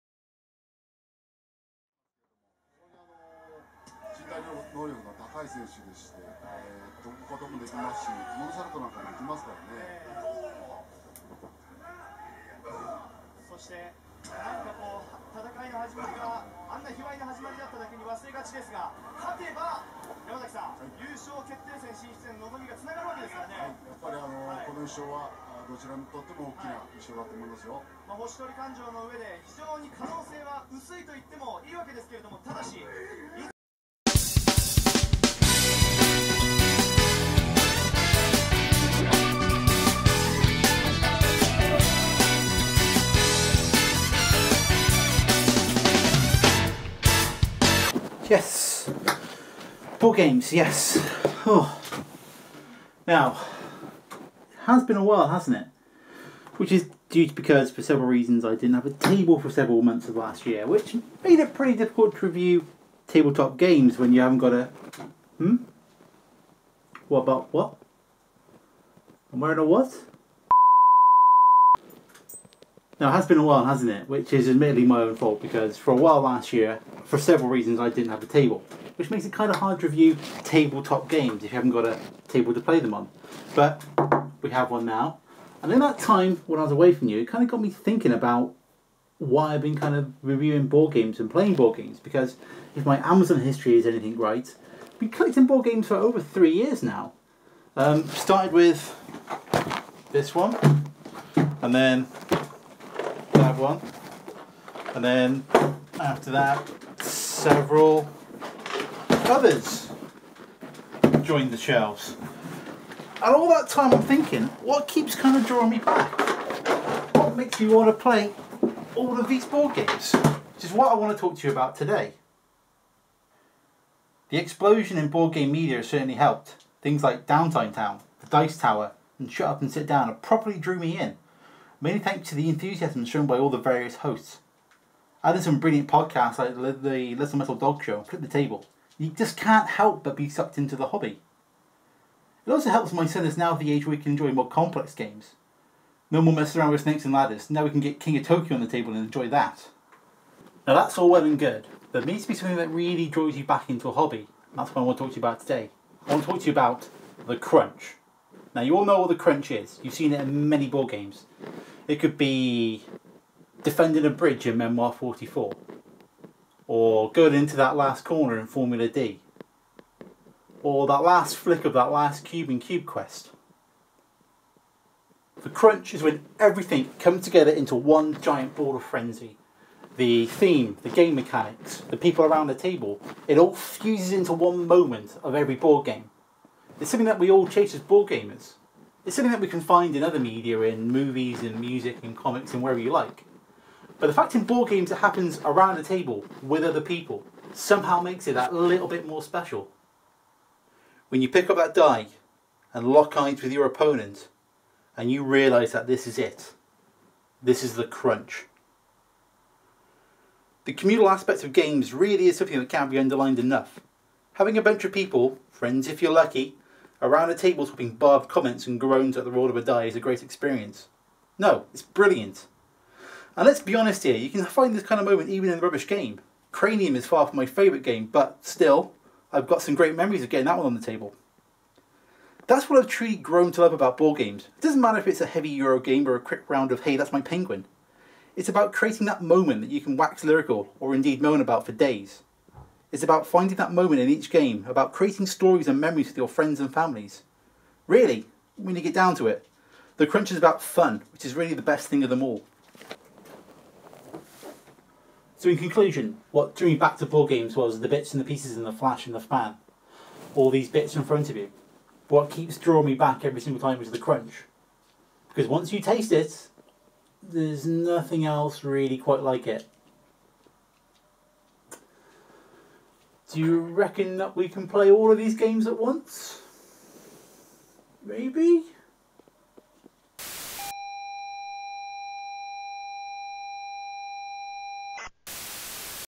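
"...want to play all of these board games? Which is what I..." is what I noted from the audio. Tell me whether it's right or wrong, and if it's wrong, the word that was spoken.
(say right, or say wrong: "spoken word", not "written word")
right.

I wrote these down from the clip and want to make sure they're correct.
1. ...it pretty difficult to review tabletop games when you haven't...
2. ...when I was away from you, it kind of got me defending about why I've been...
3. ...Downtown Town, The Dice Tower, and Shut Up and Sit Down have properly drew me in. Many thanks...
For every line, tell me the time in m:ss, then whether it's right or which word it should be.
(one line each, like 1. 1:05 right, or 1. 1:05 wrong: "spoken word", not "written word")
1. 1:01 right
2. 1:26 wrong: "thinking", not "defending"
3. 2:07 right.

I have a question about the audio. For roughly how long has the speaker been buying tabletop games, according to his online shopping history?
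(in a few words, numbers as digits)
over 3 years.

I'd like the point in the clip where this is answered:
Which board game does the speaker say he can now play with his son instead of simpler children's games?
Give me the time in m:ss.
2:27.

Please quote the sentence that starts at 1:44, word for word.
And then after that, several others joined the shelves.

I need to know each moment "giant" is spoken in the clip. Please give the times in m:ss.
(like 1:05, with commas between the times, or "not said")
2:58.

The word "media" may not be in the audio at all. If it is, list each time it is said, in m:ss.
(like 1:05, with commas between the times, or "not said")
2:05, 3:10.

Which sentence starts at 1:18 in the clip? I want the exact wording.
Which makes it kind of hard to review tabletop games if you haven't got a table to play them on.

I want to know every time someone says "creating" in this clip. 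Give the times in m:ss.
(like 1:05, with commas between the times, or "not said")
3:58, 4:04.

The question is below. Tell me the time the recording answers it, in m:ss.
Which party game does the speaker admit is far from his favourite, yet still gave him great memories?
3:46.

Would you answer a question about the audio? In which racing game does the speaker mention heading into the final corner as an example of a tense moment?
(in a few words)
Formula D.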